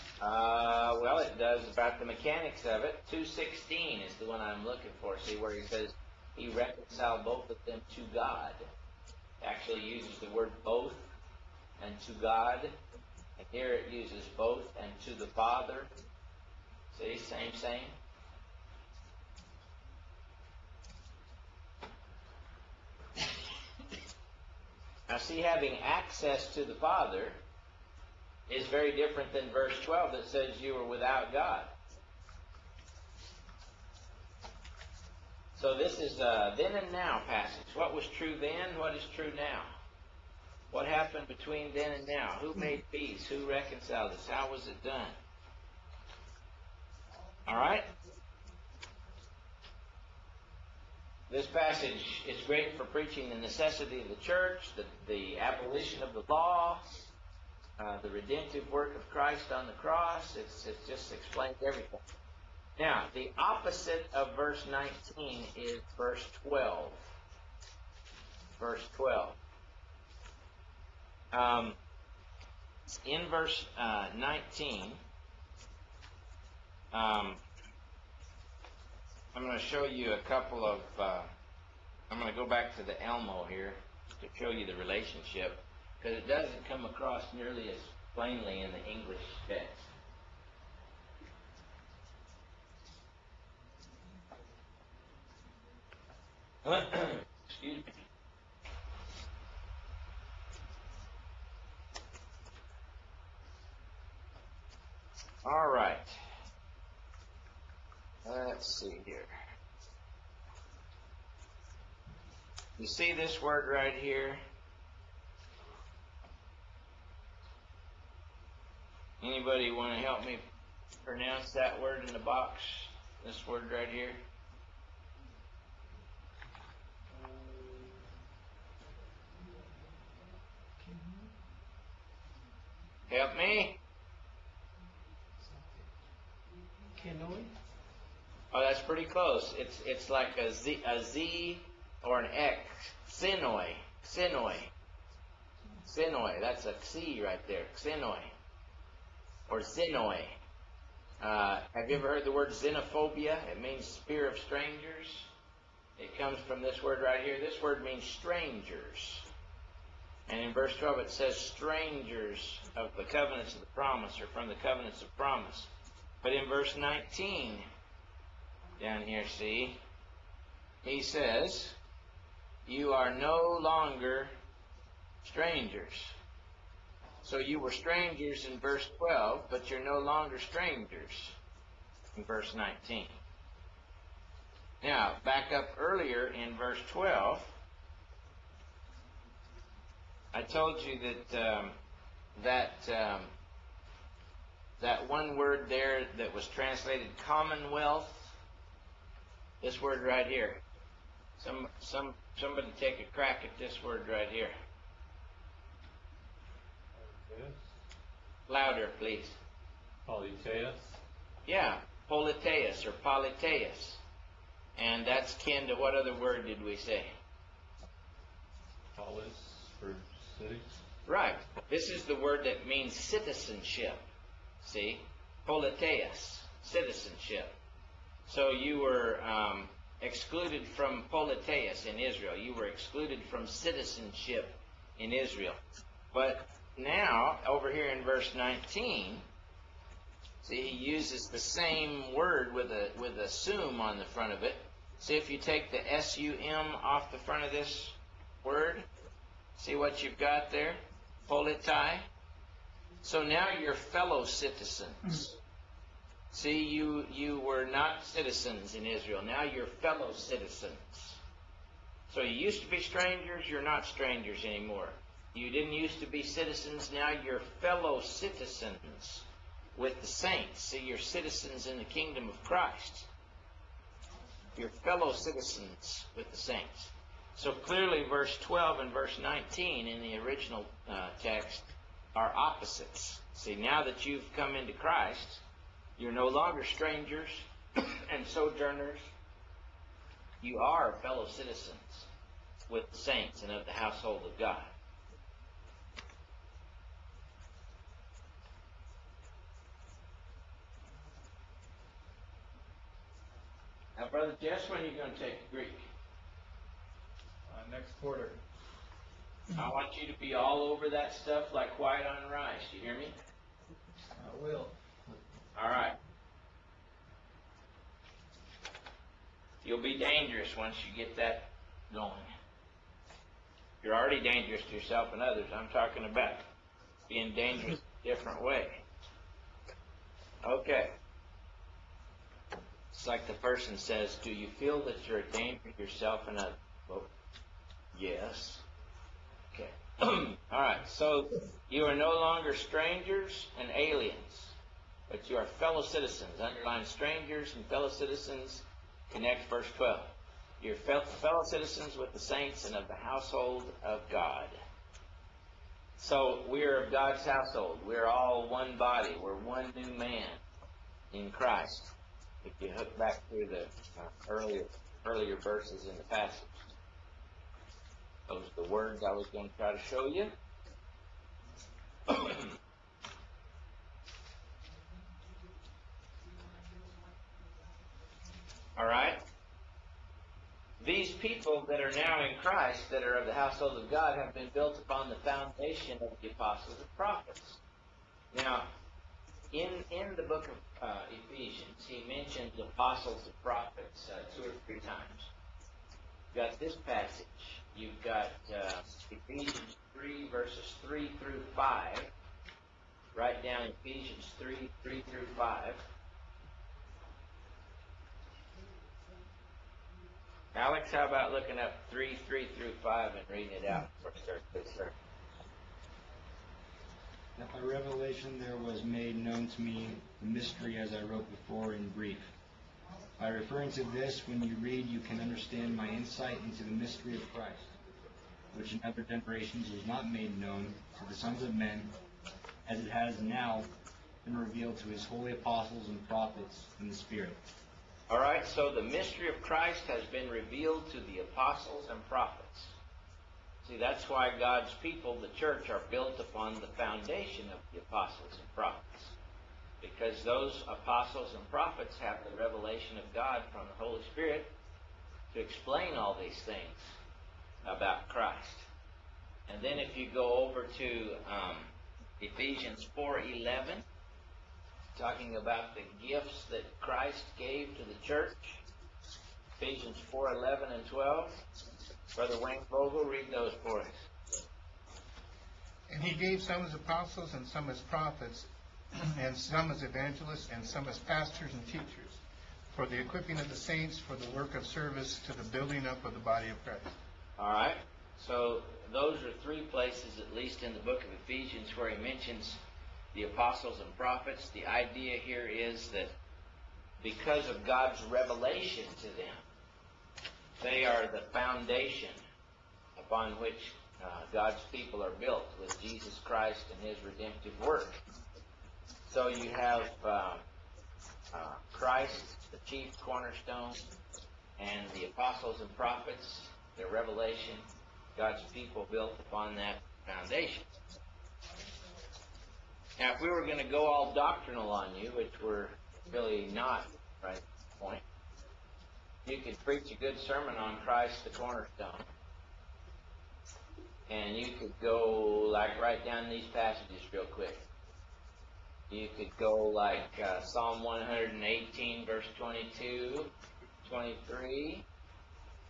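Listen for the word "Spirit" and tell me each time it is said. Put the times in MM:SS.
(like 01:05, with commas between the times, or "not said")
07:16, 07:34.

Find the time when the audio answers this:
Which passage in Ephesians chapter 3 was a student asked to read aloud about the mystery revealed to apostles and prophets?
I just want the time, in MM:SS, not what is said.
06:43.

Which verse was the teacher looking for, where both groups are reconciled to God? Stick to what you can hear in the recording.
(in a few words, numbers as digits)
2.16.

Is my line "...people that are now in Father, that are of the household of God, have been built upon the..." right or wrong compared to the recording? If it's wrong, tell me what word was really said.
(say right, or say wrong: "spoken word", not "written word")
wrong: "Christ", not "Father".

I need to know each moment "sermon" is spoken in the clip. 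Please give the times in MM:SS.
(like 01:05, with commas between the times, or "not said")
08:50.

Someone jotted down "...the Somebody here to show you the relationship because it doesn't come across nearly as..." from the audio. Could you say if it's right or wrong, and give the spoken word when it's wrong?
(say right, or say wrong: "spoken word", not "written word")
wrong: "Elmo", not "Somebody".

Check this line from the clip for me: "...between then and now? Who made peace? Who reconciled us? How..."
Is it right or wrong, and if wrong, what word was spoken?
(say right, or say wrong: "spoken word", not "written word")
right.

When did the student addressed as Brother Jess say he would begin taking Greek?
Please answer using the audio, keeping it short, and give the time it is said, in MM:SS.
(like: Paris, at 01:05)
Next quarter, at 05:07.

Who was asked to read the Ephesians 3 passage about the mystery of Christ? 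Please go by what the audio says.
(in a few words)
Alex.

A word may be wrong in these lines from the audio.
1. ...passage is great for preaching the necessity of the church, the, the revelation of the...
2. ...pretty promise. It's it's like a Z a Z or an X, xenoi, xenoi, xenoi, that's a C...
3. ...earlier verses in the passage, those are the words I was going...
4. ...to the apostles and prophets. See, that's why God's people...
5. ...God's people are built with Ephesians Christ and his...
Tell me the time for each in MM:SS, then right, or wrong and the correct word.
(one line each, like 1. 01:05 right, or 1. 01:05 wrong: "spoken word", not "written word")
1. 00:51 wrong: "abolition", not "revelation"
2. 02:18 wrong: "close", not "promise"
3. 06:05 right
4. 07:20 right
5. 08:24 wrong: "Jesus", not "Ephesians".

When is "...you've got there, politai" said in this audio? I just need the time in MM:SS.
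04:10.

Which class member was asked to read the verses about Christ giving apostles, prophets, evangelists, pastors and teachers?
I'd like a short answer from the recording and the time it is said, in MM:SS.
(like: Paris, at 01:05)
Wayne Vogel, at 07:52.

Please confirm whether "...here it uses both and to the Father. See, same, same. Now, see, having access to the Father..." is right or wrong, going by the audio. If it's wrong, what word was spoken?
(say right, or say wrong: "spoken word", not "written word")
right.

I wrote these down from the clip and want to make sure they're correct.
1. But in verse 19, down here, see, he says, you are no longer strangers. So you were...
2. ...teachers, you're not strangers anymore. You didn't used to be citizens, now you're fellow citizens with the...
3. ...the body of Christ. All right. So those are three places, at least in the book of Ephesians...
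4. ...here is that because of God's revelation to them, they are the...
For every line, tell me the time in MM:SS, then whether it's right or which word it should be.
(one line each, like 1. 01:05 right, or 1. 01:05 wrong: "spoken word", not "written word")
1. 02:46 right
2. 04:22 wrong: "strangers", not "teachers"
3. 08:06 right
4. 08:15 right.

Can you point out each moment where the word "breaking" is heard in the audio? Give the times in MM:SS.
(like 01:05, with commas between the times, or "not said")
not said.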